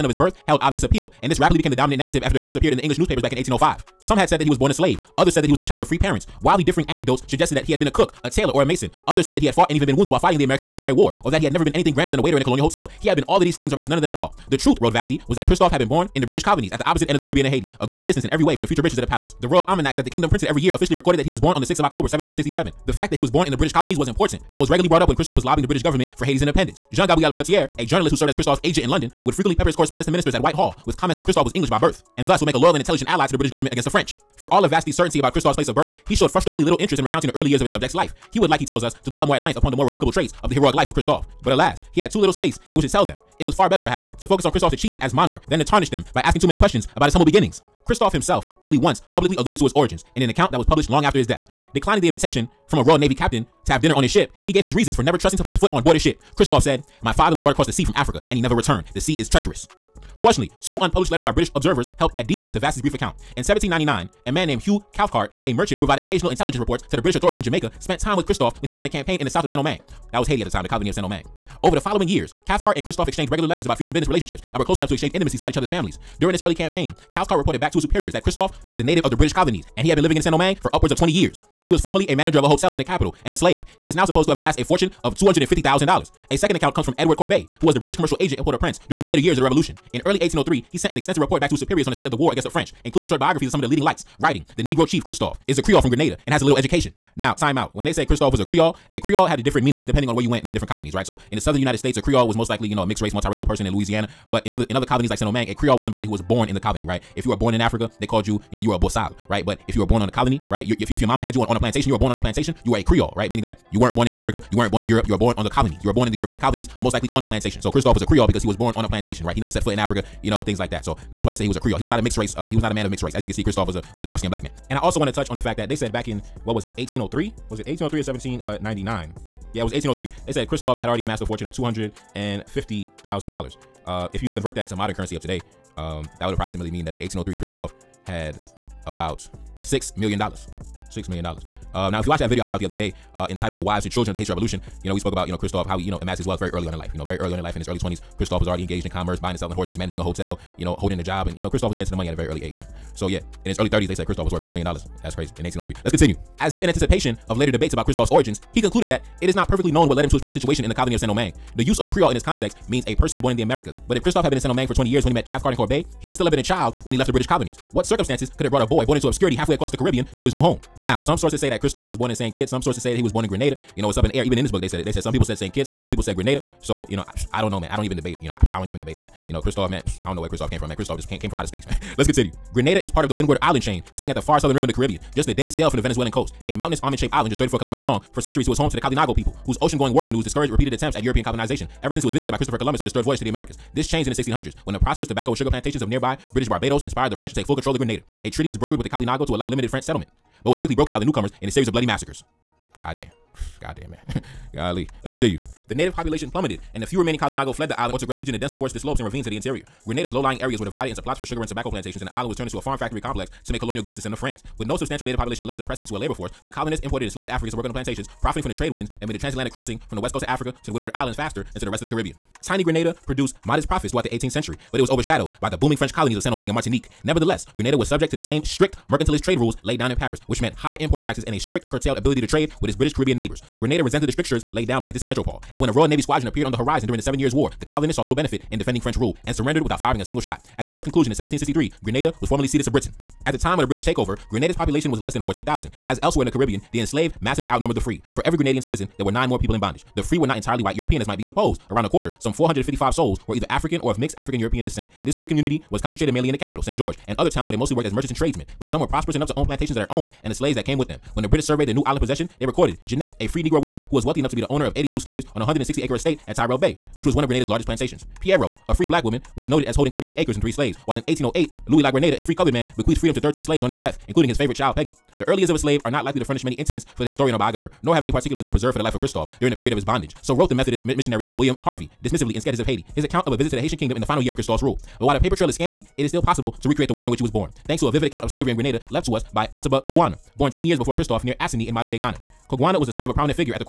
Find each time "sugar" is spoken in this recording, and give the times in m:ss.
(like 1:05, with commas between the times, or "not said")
3:15, 3:31.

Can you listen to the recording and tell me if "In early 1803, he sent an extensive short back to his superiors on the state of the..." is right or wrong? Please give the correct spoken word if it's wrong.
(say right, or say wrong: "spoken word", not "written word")
wrong: "report", not "short".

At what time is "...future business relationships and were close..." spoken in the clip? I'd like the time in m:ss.
1:13.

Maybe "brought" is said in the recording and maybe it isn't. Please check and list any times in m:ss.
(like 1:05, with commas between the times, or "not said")
0:24, 0:57, 2:48.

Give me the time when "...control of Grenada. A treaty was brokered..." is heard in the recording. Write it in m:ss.
3:17.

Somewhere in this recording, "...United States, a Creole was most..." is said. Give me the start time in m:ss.
1:41.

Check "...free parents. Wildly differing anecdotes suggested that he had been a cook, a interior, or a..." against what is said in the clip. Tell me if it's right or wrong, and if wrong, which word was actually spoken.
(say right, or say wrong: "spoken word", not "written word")
wrong: "tailor", not "interior".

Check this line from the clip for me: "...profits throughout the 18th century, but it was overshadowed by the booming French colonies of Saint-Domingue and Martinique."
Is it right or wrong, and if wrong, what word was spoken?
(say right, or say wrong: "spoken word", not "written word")
right.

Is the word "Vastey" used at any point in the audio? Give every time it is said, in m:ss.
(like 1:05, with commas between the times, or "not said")
0:14, 0:34, 1:02.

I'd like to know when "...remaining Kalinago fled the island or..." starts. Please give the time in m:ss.
3:27.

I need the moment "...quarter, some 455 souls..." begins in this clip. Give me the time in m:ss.
4:11.